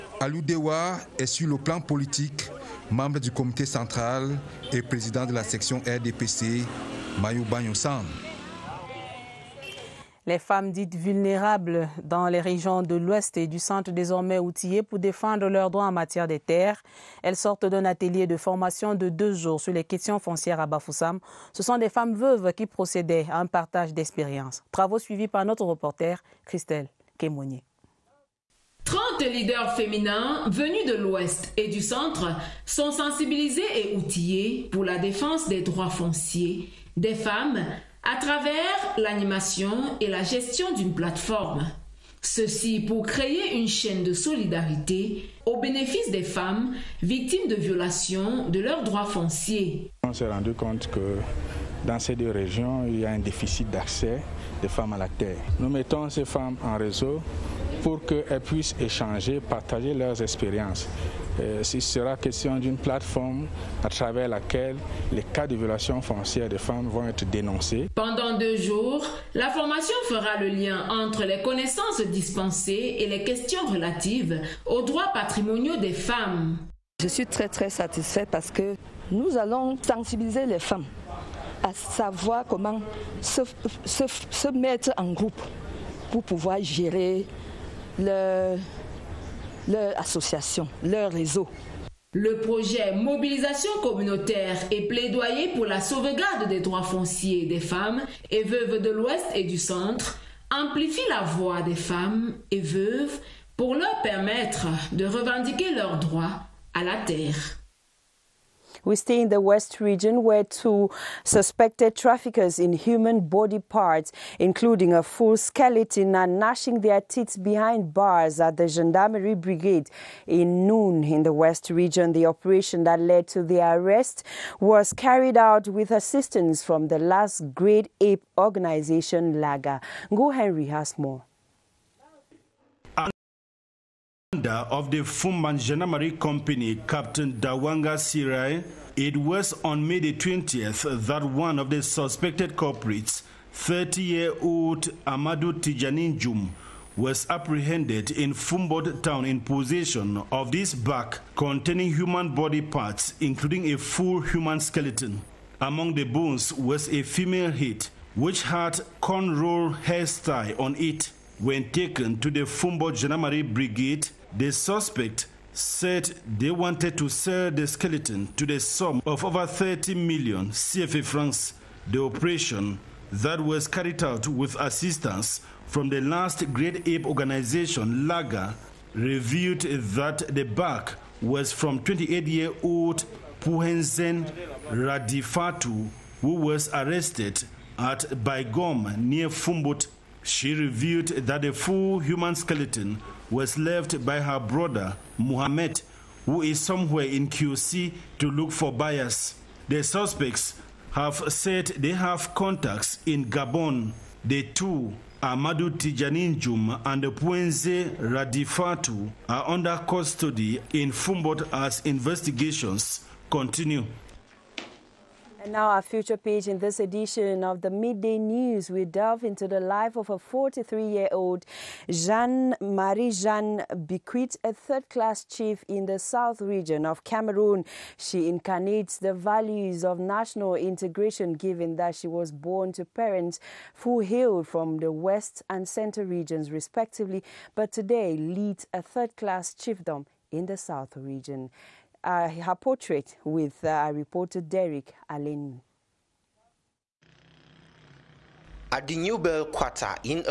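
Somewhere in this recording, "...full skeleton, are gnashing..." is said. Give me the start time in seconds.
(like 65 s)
115 s.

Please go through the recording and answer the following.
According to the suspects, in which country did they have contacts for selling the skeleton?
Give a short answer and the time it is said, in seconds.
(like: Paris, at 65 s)
Gabon, at 203 s.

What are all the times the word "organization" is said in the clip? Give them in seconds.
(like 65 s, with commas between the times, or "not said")
128 s, 177 s.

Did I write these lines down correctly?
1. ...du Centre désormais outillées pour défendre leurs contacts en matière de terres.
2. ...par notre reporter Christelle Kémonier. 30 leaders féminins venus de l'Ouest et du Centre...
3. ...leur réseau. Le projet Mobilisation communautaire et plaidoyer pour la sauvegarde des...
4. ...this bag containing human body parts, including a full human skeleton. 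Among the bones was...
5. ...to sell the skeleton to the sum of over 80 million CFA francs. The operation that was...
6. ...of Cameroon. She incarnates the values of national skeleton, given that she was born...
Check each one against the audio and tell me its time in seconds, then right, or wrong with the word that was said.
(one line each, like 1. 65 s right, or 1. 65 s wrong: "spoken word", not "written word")
1. 13 s wrong: "droits", not "contacts"
2. 25 s right
3. 90 s right
4. 150 s right
5. 166 s wrong: "30", not "80"
6. 226 s wrong: "integration", not "skeleton".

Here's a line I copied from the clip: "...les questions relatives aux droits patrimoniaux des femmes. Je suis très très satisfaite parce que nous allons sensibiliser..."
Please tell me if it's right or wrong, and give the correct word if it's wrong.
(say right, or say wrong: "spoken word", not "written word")
right.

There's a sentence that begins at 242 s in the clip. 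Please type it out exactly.
Uh, her portrait with uh, reporter Derek Allen.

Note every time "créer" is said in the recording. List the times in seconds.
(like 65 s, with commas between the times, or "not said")
43 s.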